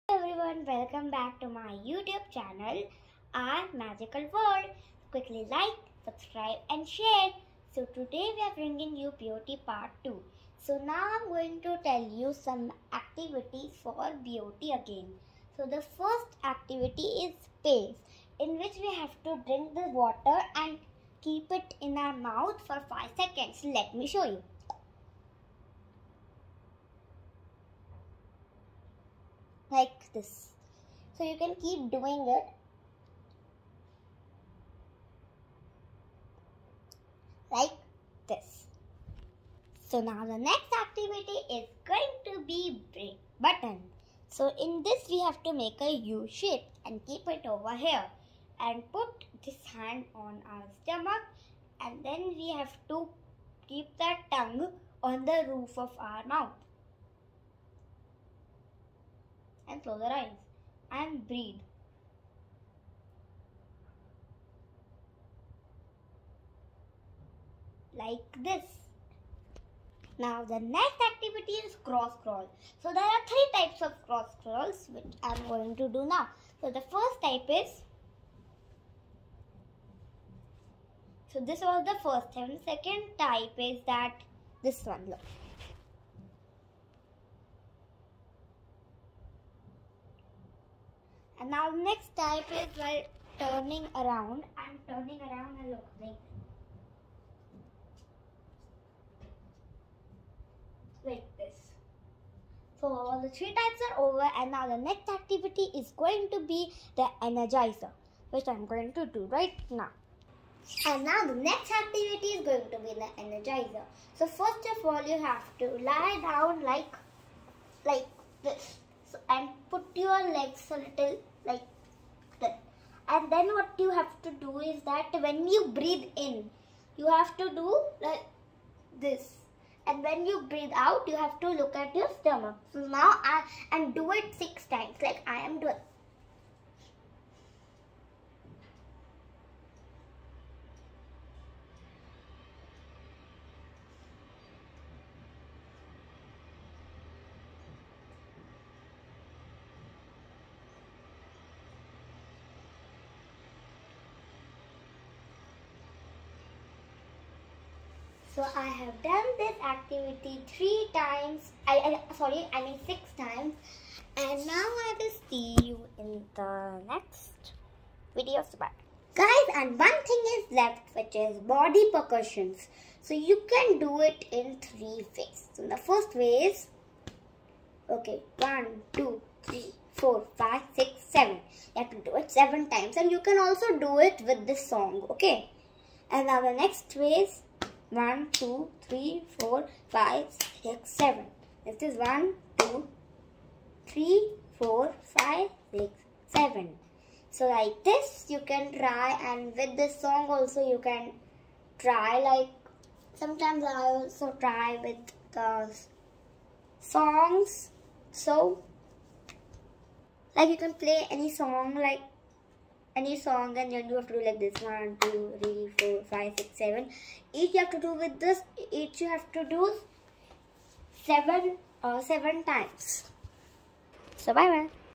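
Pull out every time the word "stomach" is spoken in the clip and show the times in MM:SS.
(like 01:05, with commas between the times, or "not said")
00:50, 02:12.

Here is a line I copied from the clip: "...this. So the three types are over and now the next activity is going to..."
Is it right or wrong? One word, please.
right.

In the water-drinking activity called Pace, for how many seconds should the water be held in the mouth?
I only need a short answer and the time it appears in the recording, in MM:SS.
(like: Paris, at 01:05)
5 seconds, at 00:22.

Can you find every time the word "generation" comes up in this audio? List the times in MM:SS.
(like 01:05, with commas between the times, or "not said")
not said.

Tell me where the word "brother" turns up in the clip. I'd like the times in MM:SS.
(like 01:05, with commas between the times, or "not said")
not said.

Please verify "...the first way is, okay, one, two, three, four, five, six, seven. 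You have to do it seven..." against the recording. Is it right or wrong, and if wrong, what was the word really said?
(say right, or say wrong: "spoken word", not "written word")
right.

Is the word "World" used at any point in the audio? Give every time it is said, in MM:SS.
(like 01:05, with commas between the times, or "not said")
00:04.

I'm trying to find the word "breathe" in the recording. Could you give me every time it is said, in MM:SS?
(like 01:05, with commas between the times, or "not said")
01:01, 02:05, 02:10.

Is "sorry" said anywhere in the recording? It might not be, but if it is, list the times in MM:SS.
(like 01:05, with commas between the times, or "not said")
02:42.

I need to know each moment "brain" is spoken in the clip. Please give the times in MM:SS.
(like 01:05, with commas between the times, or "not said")
00:42.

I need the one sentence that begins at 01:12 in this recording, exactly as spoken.
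So there are three types of cross crawls which I'm going to do now.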